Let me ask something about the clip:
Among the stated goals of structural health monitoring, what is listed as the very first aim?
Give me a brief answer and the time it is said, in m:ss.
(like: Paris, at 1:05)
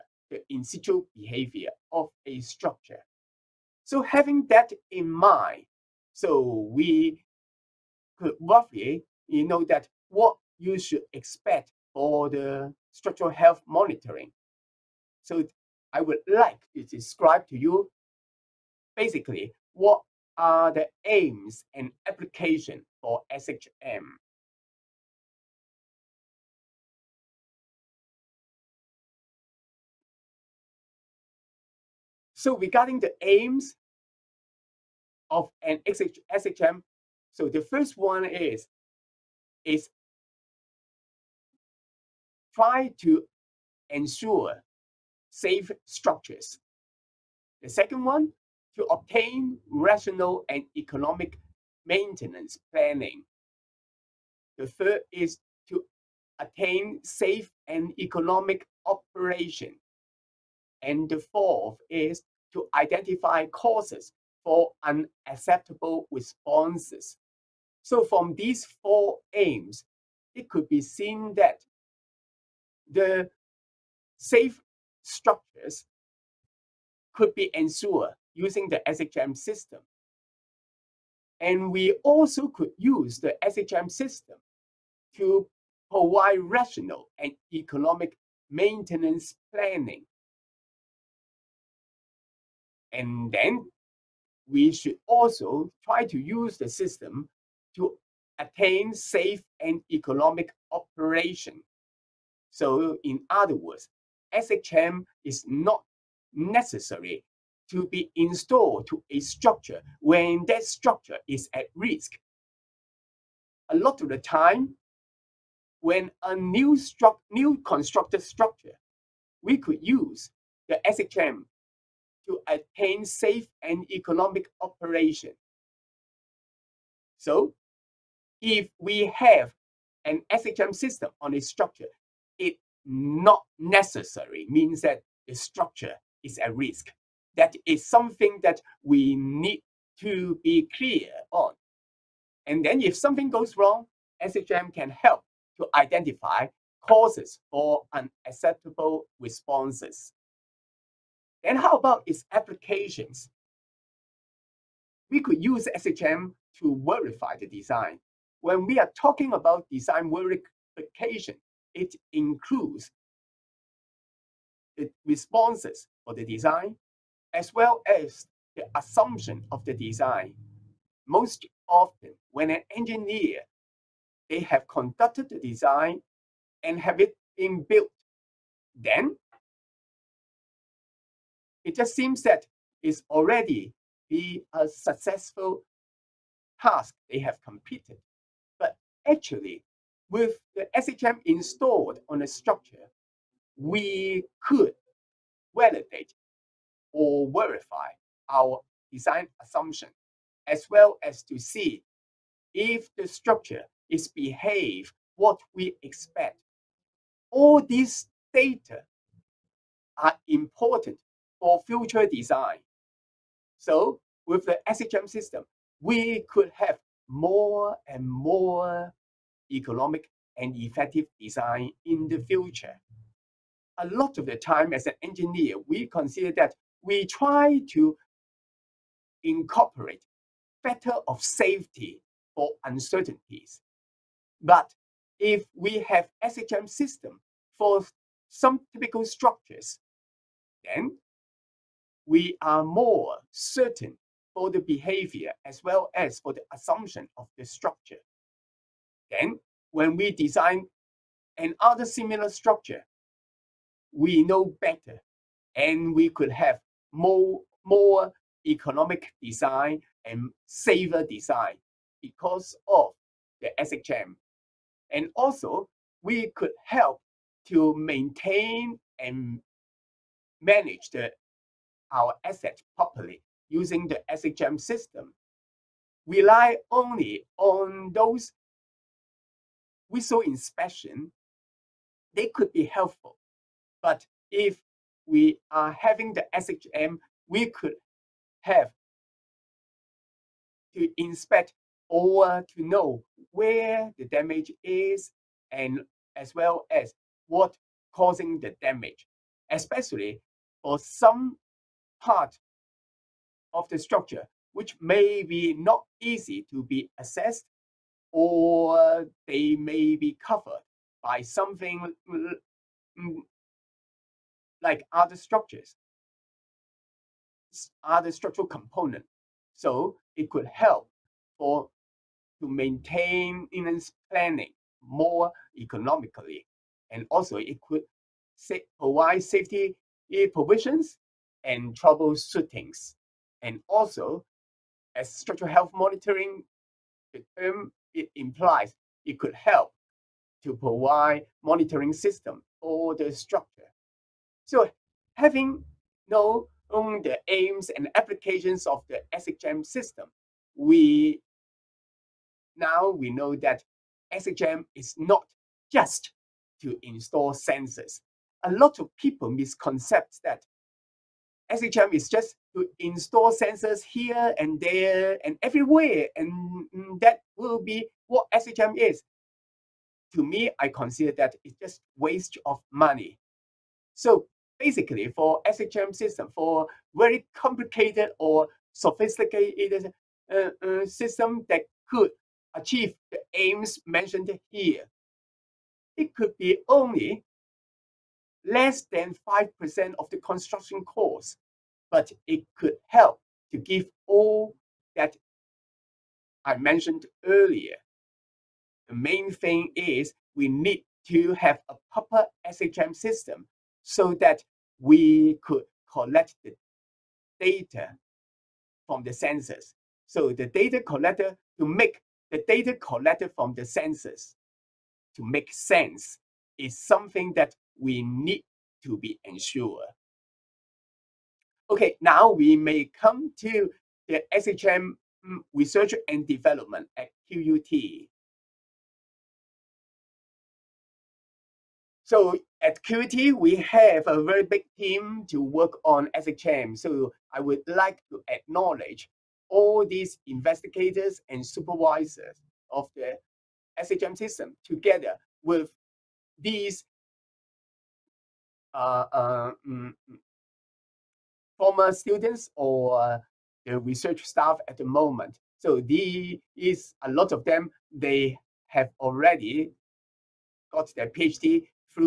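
Ensure safe structures, at 0:43.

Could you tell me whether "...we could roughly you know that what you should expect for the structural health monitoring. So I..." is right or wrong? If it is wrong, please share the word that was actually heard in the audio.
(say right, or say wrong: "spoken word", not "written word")
right.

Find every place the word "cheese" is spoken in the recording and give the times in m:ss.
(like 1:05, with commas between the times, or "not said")
not said.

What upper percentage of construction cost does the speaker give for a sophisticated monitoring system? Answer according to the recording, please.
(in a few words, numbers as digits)
5%.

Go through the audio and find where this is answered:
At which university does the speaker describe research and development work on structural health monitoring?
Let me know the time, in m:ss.
7:07.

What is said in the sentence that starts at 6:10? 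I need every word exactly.
To me, I consider that it's just waste of money.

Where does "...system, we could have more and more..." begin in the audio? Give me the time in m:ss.
3:35.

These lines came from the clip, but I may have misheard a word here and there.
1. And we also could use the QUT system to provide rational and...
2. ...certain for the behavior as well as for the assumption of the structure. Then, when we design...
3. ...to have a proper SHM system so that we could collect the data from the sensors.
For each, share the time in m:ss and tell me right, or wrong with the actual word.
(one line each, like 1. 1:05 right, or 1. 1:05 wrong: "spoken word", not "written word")
1. 1:21 wrong: "SHM", not "QUT"
2. 4:03 right
3. 6:41 right.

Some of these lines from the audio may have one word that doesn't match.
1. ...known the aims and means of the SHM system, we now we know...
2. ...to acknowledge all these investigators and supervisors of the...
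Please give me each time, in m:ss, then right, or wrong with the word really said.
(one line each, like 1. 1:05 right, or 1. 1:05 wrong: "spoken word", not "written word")
1. 5:46 wrong: "applications", not "means"
2. 7:18 right.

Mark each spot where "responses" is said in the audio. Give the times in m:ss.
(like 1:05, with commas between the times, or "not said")
1:06, 2:29, 2:45.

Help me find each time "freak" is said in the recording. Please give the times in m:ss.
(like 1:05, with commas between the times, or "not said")
not said.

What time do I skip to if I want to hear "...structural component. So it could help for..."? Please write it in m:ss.
5:18.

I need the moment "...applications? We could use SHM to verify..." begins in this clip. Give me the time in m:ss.
2:32.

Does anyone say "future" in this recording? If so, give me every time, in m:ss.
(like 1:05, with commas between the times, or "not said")
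3:31, 3:42.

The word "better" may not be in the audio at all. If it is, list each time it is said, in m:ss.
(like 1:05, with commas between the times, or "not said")
3:50, 4:14.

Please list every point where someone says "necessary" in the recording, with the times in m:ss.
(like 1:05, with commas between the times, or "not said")
1:46, 2:13.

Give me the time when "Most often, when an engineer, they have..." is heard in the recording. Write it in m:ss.
2:51.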